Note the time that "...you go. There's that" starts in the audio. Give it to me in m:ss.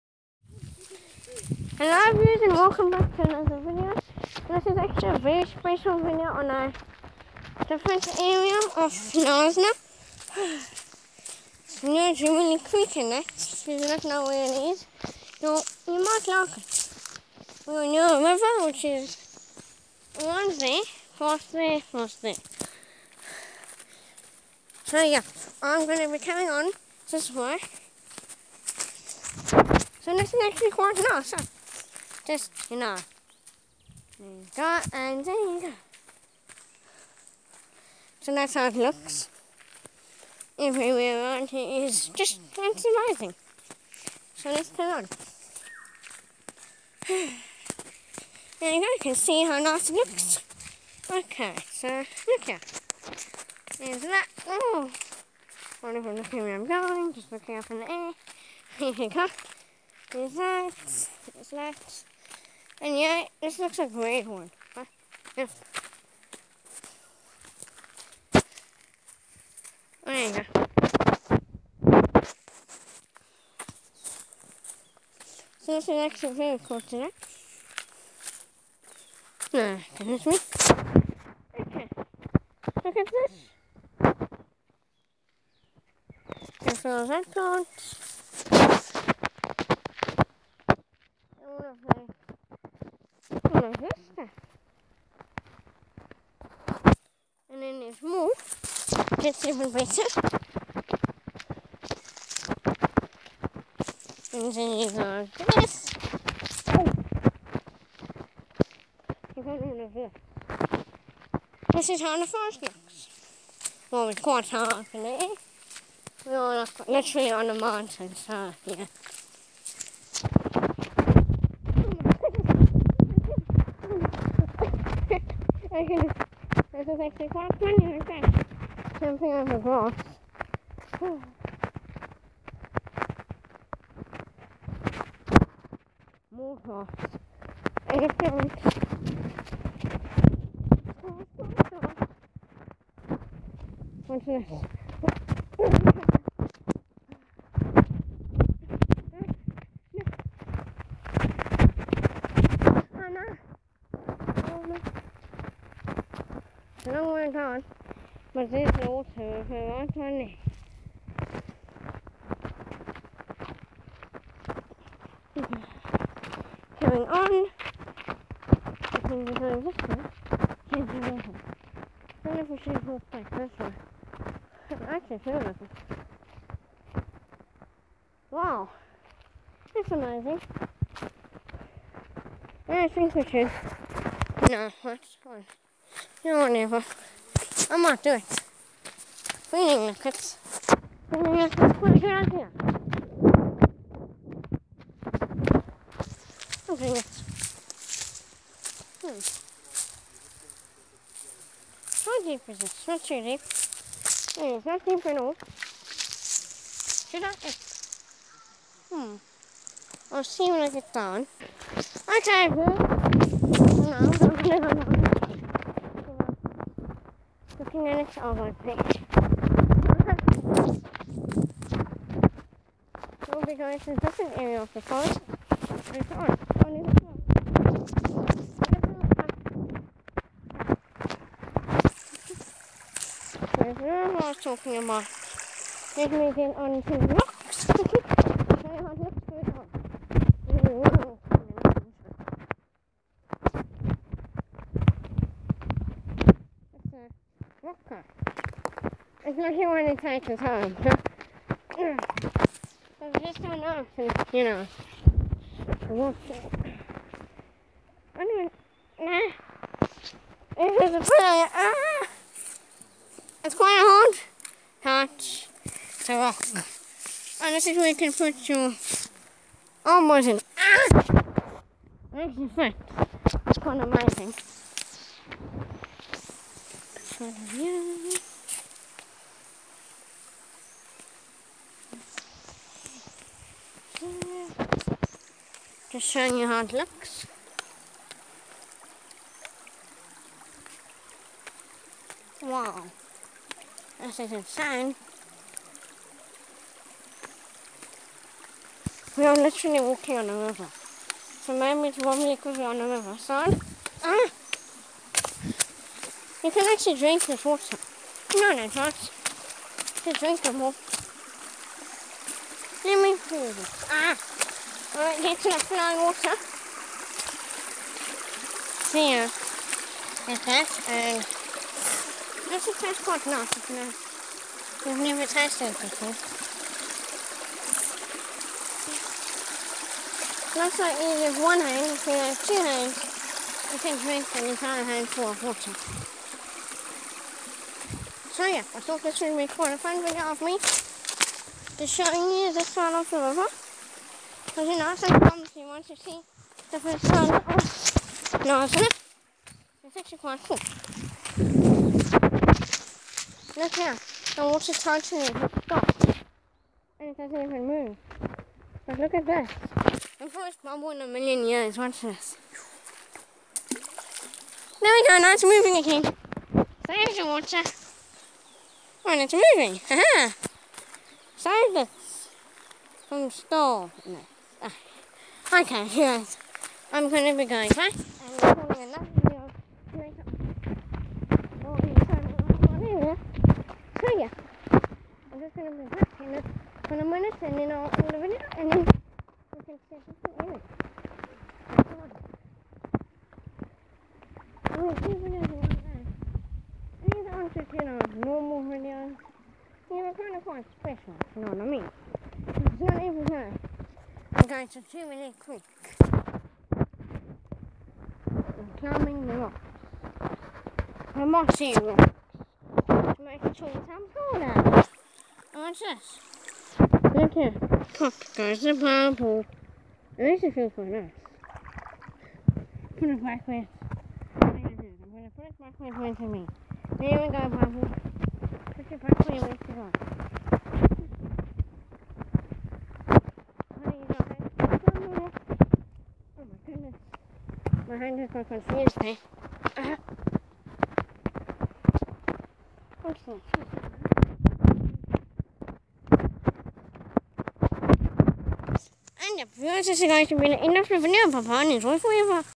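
0:58.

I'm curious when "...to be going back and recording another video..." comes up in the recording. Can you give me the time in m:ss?
6:17.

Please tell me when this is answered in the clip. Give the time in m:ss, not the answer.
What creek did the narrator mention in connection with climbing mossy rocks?
6:44.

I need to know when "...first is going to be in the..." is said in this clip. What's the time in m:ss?
7:29.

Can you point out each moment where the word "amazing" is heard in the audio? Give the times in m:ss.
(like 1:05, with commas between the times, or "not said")
0:42, 2:59, 4:33.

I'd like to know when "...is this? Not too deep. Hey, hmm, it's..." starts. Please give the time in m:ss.
3:22.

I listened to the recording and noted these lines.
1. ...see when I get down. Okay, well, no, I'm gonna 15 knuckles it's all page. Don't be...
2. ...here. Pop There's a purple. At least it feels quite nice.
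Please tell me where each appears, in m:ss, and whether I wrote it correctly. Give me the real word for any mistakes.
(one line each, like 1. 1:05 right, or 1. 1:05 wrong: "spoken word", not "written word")
1. 3:30 wrong: "minutes", not "knuckles"
2. 6:57 right.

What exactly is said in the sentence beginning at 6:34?
I'm oh, going to do videos like that.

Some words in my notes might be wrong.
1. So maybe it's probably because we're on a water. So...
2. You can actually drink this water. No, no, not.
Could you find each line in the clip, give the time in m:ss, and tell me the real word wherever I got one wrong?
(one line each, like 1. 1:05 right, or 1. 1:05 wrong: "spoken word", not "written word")
1. 5:01 wrong: "river", not "water"
2. 5:06 right.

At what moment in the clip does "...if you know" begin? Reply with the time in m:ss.
5:23.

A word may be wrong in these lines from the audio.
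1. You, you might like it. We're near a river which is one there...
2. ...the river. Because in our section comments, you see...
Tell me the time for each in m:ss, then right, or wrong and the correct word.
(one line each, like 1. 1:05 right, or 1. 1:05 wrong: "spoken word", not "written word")
1. 0:15 right
2. 5:43 right.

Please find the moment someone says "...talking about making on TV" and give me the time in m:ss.
3:54.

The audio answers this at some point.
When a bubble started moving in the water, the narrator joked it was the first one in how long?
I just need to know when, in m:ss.
6:01.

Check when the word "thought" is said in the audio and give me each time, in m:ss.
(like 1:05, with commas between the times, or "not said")
5:38.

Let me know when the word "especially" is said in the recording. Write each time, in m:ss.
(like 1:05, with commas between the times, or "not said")
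4:09.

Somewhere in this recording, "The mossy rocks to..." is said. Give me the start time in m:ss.
6:51.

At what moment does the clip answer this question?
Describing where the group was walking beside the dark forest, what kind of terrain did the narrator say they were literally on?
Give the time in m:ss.
1:57.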